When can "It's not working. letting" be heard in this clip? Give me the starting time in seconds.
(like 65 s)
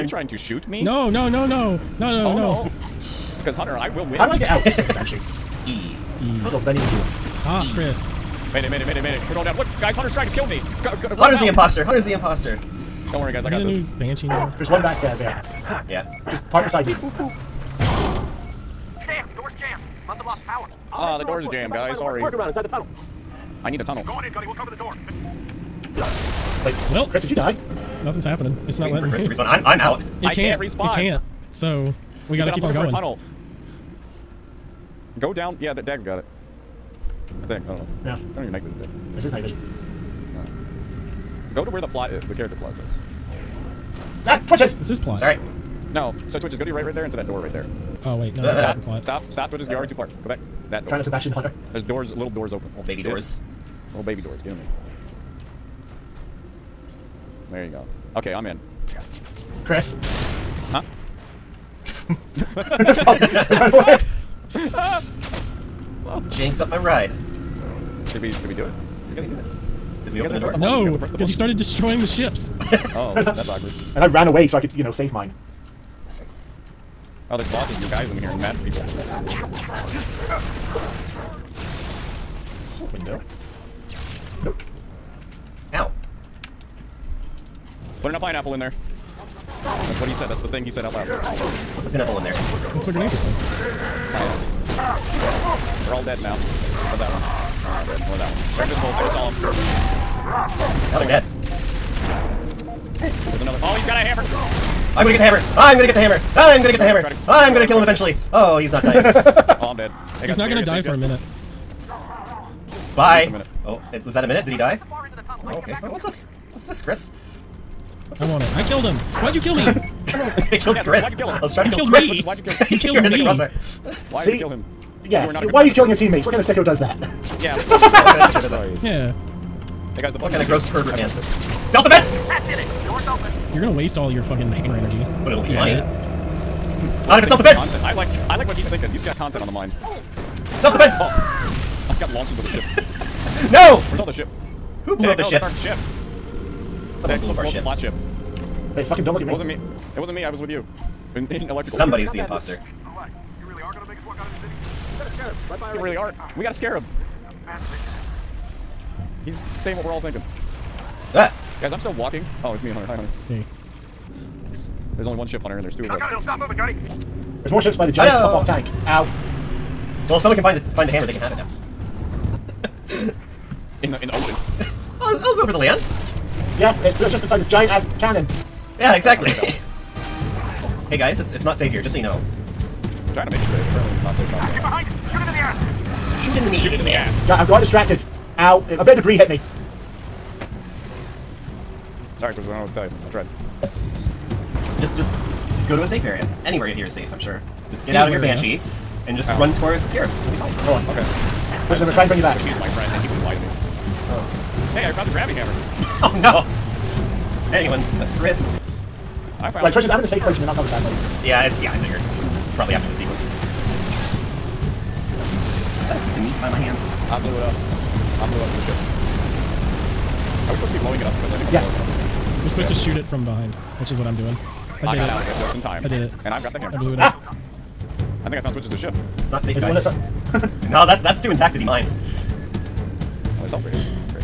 28 s.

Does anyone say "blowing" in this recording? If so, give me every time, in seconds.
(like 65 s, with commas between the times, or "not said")
220 s.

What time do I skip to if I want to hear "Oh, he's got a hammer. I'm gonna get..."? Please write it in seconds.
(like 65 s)
103 s.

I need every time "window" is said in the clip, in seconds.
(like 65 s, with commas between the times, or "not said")
82 s.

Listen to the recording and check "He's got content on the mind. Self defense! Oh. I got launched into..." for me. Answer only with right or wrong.
right.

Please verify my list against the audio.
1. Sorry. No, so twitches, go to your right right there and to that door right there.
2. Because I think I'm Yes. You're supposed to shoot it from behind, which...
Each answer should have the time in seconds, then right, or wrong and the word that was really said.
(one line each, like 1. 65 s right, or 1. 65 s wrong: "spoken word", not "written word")
1. 45 s right
2. 221 s right.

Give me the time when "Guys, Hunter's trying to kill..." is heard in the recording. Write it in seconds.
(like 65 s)
9 s.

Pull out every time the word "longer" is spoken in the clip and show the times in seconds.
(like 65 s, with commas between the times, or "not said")
not said.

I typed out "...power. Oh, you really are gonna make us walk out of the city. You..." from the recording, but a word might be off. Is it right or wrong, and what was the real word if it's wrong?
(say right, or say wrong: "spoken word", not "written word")
wrong: "imposter", not "power".